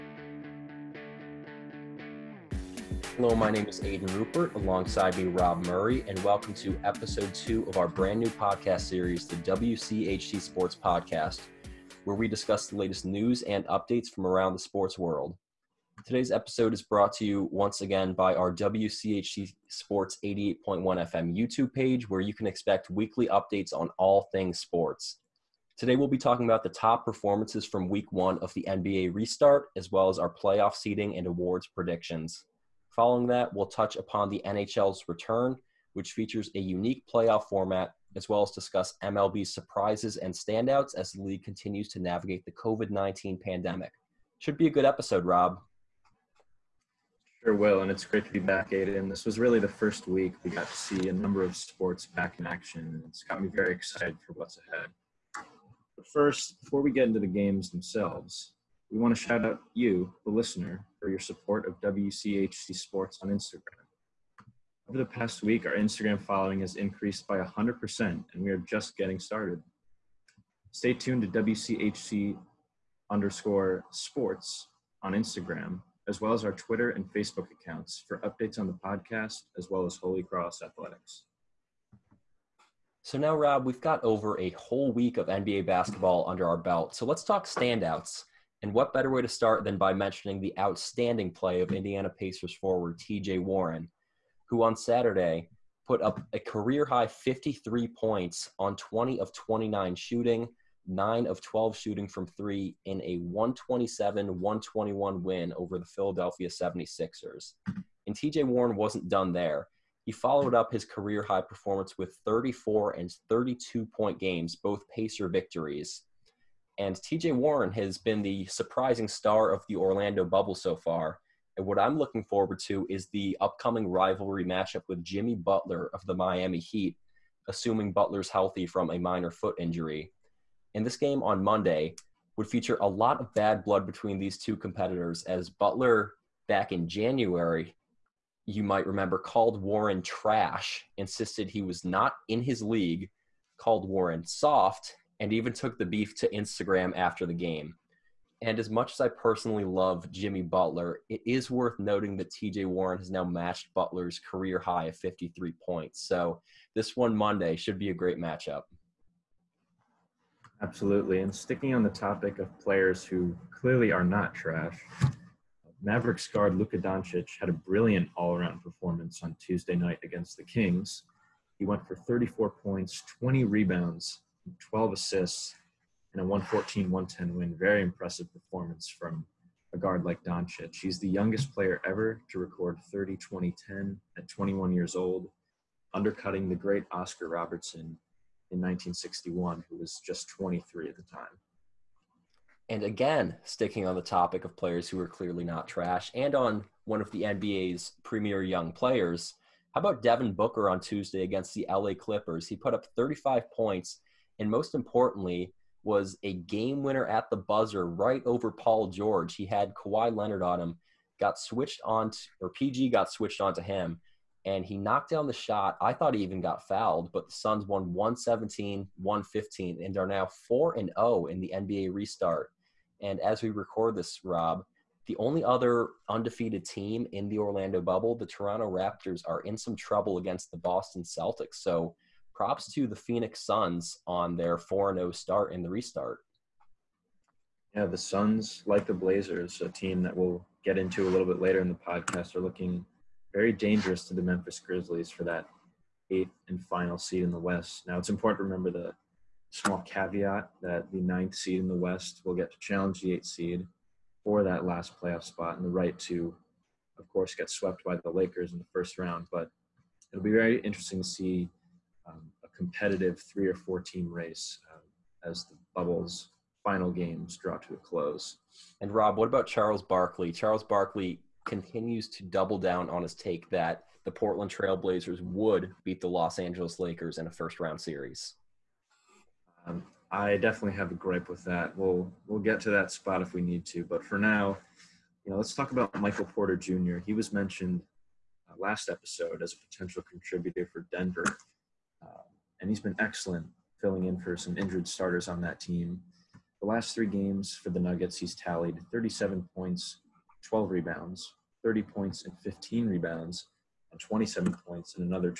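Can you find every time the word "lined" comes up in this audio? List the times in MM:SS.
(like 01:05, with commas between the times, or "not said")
not said.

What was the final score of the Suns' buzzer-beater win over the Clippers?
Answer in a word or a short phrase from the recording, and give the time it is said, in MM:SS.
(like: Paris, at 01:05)
117-115, at 03:37.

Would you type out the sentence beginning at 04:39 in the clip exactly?
Um, I definitely have a gripe with that.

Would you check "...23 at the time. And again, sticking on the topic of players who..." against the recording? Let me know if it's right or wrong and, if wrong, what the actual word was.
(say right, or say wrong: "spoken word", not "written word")
right.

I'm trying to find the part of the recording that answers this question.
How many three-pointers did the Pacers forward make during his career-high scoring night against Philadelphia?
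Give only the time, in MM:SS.
01:40.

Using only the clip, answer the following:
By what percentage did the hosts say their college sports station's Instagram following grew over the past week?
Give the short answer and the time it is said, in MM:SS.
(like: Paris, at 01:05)
100%, at 01:07.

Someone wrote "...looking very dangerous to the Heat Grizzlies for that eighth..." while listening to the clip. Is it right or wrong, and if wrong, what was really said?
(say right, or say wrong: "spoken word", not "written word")
wrong: "Memphis", not "Heat".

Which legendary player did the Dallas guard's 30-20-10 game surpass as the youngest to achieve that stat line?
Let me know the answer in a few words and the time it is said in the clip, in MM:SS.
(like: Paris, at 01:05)
Oscar Robertson, at 03:06.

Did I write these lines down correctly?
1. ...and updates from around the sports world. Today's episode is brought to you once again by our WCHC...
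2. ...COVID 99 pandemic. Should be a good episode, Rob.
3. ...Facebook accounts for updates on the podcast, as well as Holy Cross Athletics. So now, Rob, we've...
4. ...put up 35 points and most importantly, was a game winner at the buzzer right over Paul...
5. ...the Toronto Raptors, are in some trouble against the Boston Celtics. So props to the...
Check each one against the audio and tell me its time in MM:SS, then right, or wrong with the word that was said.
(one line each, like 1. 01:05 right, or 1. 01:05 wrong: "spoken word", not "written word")
1. 00:13 right
2. 00:42 wrong: "19", not "99"
3. 01:17 right
4. 03:22 right
5. 03:48 right.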